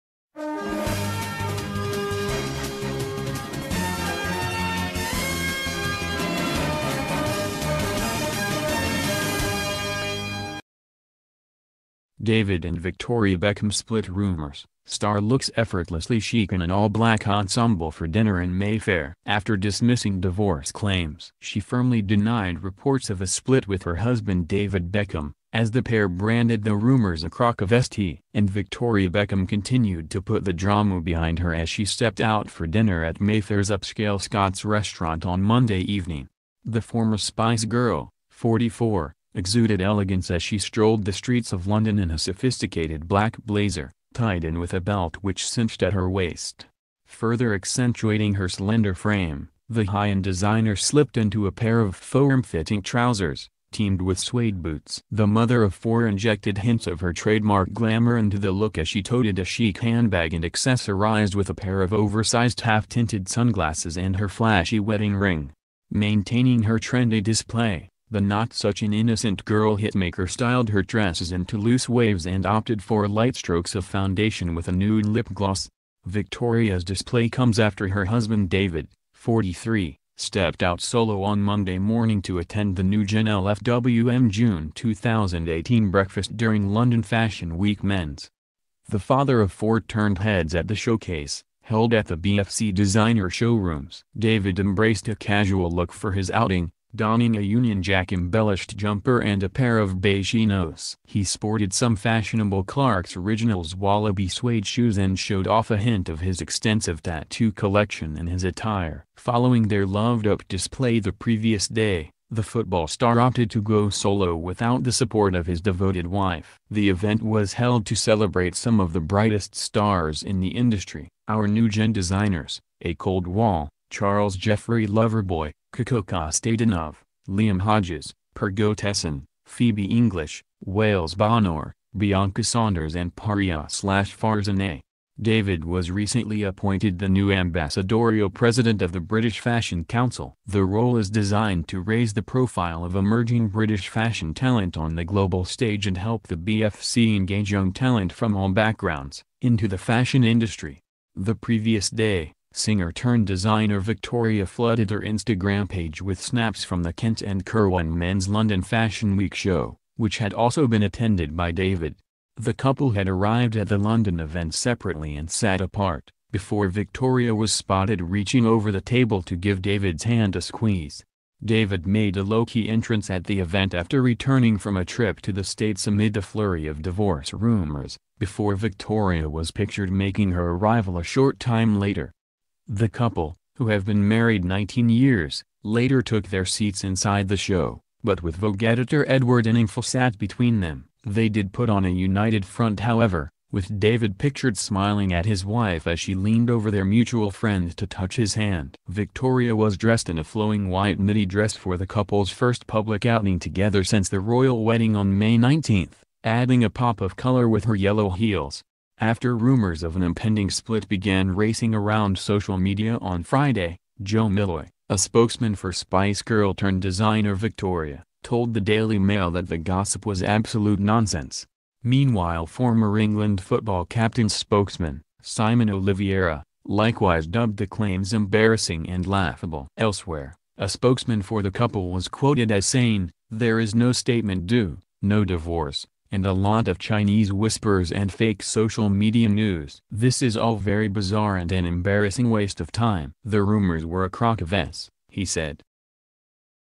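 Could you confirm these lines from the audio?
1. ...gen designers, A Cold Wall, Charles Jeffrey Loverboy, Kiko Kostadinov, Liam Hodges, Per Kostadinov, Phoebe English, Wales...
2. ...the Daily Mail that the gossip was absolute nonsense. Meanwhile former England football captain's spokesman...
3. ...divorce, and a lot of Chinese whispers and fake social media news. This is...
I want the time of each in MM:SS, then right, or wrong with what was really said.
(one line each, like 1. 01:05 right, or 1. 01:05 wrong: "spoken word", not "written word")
1. 02:01 wrong: "Götesson", not "Kostadinov"
2. 03:38 right
3. 03:55 right.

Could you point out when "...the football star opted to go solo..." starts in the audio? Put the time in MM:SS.
01:52.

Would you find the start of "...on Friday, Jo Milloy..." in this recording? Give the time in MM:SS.
03:33.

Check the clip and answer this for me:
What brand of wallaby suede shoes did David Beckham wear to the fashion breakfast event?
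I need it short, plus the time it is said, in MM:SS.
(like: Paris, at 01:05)
Clark's Originals, at 01:42.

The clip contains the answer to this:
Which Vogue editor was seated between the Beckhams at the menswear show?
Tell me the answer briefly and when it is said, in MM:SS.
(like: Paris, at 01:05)
Edward Enninful, at 03:09.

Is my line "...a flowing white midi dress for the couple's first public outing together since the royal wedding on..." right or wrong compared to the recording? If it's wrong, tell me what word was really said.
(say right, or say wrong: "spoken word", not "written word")
right.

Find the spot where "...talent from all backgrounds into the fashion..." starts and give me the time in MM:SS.
02:27.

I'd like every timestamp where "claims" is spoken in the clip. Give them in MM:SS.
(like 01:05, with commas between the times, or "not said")
00:20, 03:47.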